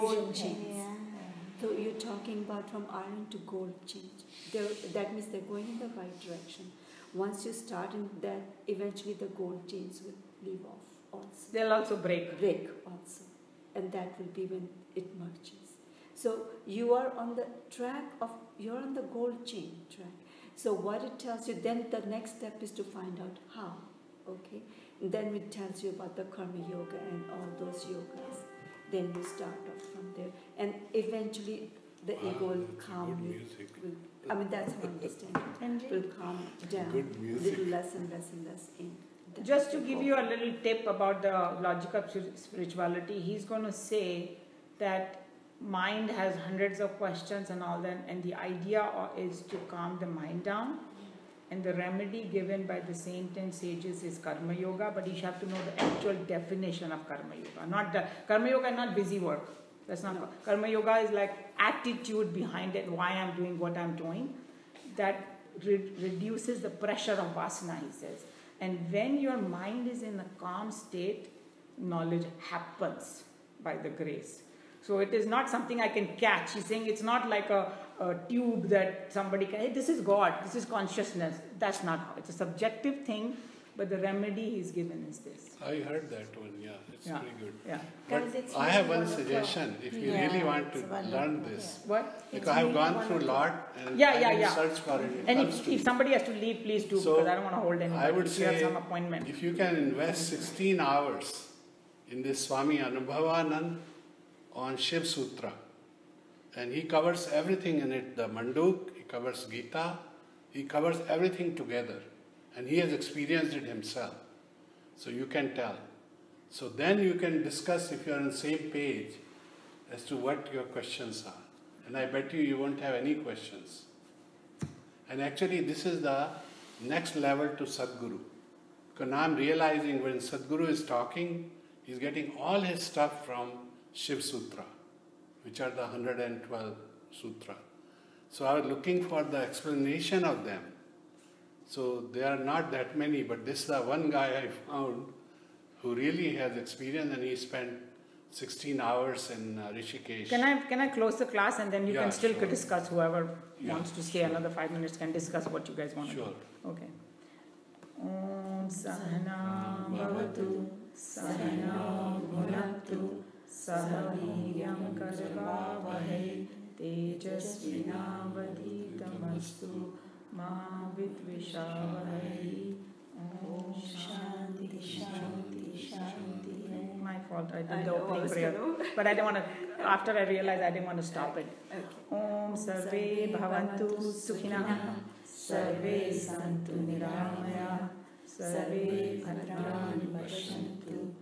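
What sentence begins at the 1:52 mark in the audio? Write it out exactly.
And he has experienced it himself.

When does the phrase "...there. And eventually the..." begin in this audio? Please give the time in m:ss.
0:30.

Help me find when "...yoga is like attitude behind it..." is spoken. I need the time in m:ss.
1:00.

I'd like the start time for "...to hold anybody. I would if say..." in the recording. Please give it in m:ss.
1:37.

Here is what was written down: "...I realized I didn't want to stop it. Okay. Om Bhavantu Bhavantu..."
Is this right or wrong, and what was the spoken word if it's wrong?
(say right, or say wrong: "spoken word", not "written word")
wrong: "Sarve", not "Bhavantu".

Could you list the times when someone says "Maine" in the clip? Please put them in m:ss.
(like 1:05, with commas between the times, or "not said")
not said.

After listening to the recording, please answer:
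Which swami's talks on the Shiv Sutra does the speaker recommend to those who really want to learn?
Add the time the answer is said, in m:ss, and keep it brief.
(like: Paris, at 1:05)
Swami Anubhavanand, at 1:42.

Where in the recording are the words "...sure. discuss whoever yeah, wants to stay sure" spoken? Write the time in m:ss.
2:32.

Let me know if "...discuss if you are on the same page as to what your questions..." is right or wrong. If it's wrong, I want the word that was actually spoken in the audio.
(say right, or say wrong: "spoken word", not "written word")
right.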